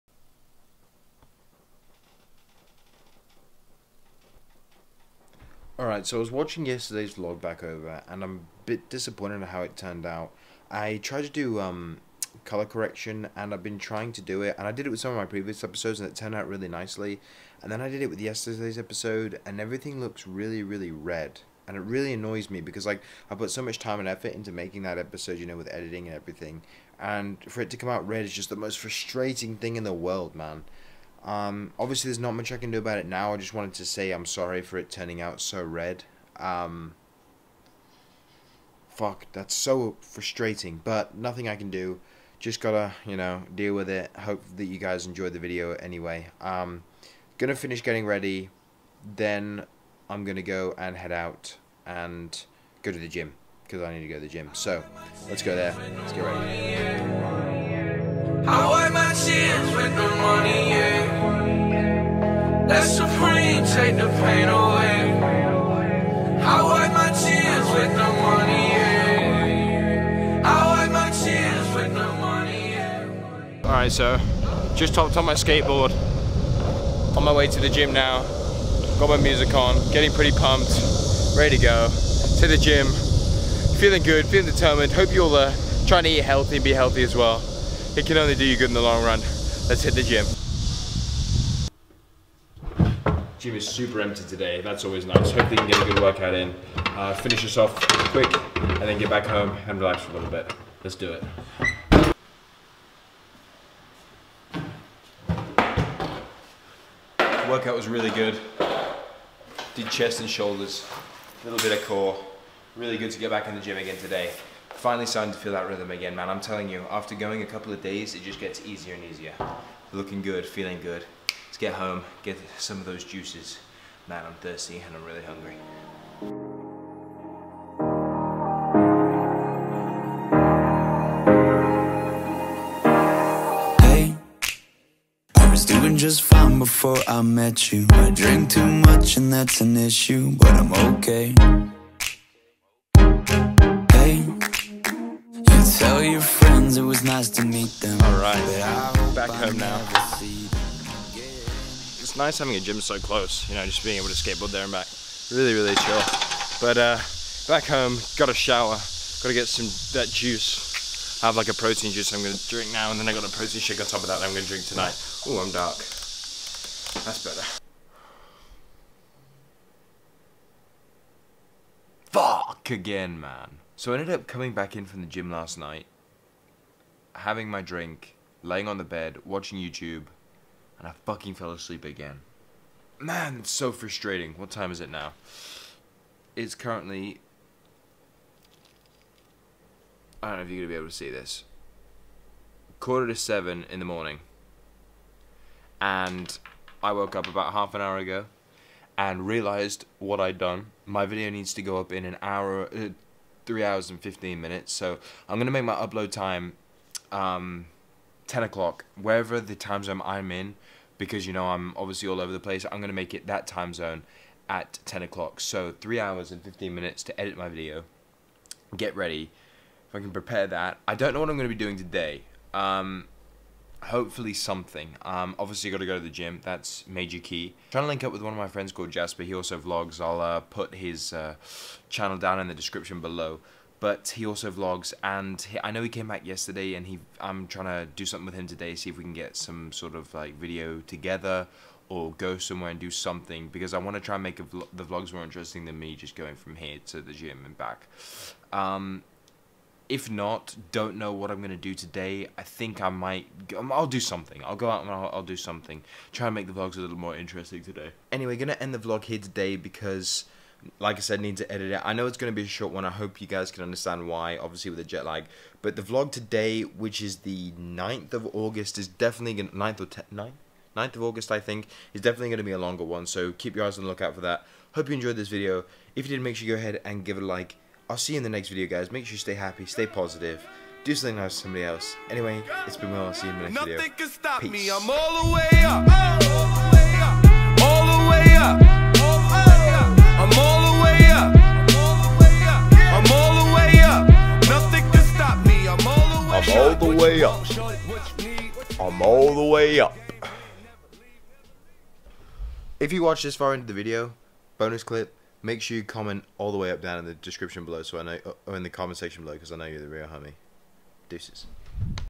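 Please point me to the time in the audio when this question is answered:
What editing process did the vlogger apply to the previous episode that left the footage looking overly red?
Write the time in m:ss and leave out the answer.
0:12.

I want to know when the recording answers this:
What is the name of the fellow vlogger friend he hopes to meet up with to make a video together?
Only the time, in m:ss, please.
3:48.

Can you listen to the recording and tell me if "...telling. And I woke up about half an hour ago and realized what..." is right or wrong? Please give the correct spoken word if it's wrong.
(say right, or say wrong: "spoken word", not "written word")
wrong: "morning", not "telling".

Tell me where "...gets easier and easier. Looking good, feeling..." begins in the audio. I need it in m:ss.
1:58.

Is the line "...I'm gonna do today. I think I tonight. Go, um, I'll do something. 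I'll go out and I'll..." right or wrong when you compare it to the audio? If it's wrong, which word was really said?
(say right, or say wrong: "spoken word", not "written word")
wrong: "might", not "tonight".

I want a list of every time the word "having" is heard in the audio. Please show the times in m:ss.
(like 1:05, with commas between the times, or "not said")
2:32, 2:57.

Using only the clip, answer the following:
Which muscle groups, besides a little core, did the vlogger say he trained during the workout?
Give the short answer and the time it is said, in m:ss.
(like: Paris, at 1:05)
chest and shoulders, at 1:49.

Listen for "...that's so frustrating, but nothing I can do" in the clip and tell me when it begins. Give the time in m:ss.
0:39.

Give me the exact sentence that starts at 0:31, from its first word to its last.
Um, obviously, there's not much I can do about it now.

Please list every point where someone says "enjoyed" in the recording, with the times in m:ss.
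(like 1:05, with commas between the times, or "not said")
0:45, 4:34.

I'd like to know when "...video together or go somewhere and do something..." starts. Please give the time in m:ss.
4:00.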